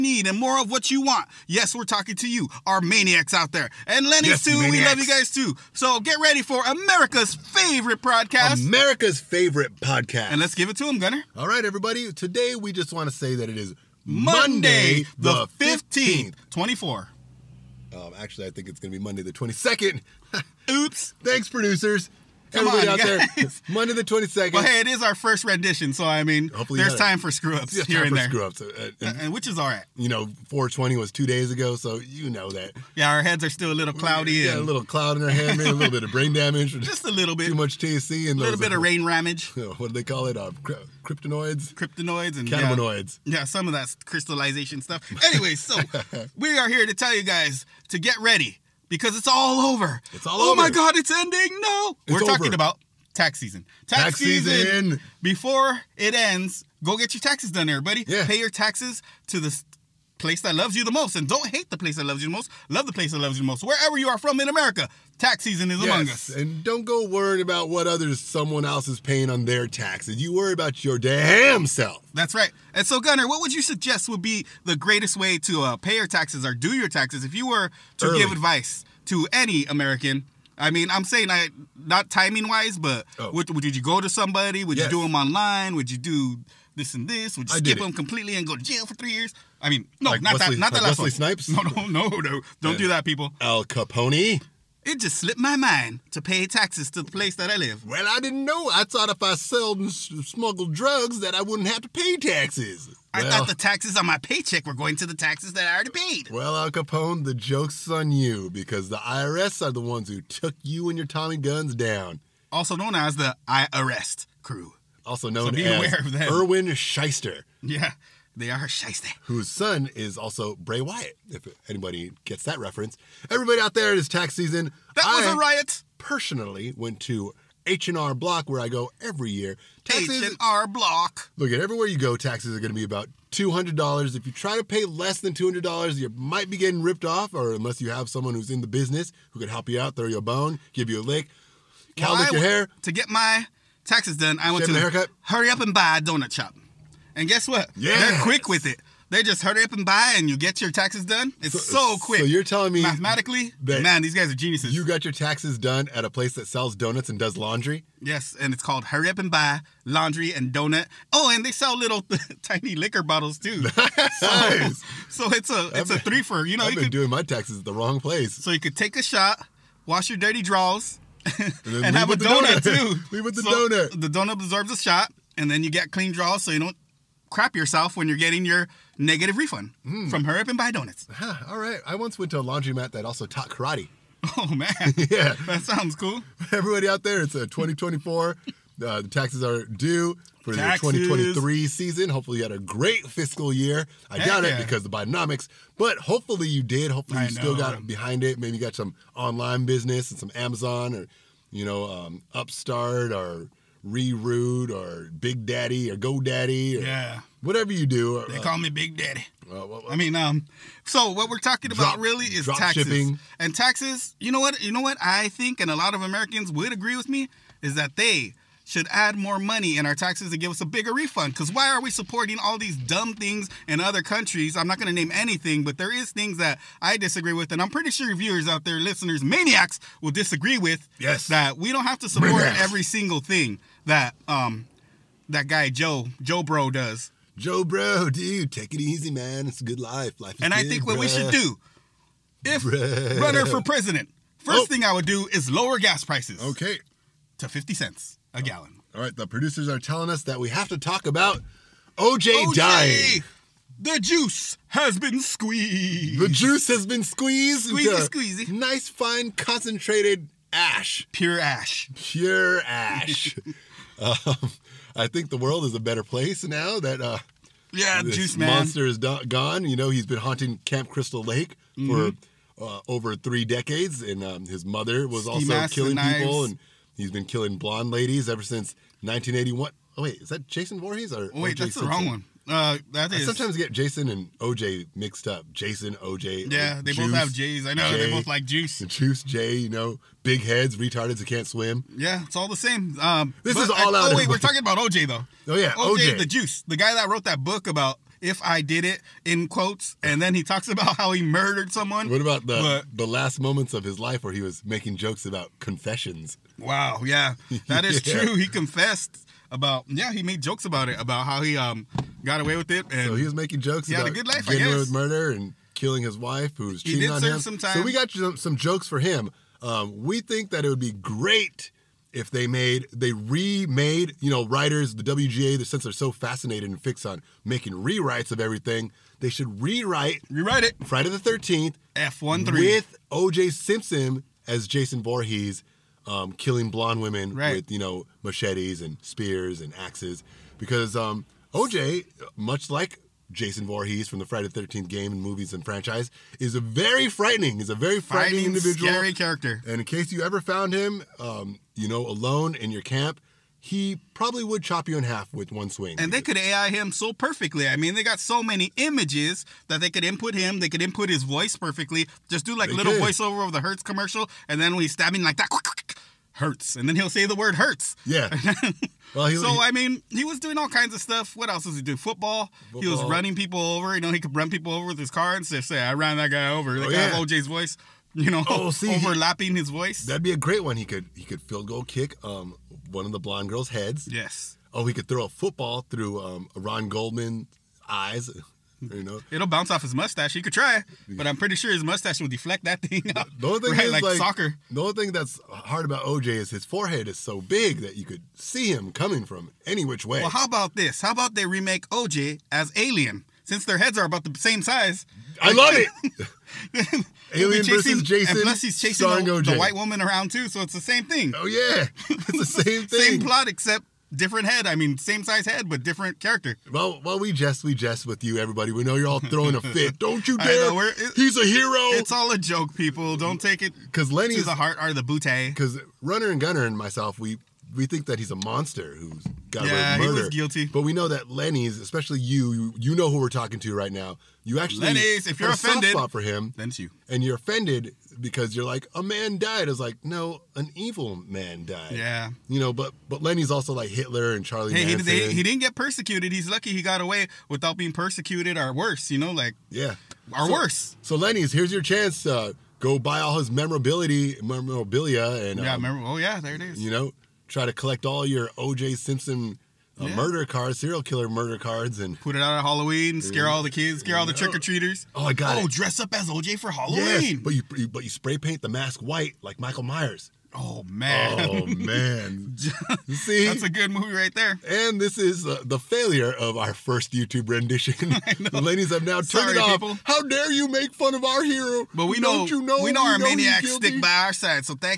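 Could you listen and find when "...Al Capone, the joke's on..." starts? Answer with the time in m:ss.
1:46.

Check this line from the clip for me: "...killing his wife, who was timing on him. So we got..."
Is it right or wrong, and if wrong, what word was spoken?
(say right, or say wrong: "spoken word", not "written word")
wrong: "cheating", not "timing".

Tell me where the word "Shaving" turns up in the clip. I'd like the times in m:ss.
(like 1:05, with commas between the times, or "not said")
2:24.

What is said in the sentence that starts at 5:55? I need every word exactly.
And they could AI him so perfectly.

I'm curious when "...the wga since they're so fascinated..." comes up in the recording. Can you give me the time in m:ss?
5:24.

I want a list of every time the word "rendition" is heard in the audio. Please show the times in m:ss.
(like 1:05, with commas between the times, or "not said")
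0:25, 7:57.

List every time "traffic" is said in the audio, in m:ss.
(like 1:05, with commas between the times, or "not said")
not said.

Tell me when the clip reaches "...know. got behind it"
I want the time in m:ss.
3:17.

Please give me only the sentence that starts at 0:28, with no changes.
Screw ups, uh, uh, uh which is all right.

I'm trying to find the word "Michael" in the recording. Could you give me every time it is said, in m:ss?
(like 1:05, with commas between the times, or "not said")
7:49.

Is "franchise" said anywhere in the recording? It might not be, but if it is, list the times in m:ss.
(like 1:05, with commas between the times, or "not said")
5:45.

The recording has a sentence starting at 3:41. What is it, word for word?
Because why are we supporting all these dumb things in other countries?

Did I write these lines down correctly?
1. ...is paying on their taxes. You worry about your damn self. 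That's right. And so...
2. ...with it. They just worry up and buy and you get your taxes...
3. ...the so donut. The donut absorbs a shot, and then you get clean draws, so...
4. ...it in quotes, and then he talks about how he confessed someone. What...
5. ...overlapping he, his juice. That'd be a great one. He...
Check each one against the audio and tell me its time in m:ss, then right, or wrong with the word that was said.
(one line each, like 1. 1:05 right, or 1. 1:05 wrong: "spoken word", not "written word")
1. 1:08 right
2. 2:28 wrong: "hurry", not "worry"
3. 2:53 right
4. 4:58 wrong: "murdered", not "confessed"
5. 6:18 wrong: "voice", not "juice".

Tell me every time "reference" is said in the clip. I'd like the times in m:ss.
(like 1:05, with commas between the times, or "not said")
2:02.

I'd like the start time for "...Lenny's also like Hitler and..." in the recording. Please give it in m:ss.
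7:23.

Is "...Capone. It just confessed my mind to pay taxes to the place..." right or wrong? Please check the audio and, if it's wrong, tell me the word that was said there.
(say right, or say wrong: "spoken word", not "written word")
wrong: "slipped", not "confessed".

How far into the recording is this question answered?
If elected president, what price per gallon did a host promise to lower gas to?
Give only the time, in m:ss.
4:07.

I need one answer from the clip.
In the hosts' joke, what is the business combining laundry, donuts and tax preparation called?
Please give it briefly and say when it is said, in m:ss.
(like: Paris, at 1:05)
Hurry Up and Buy Laundry and Donut, at 2:38.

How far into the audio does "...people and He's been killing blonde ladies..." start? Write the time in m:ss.
4:35.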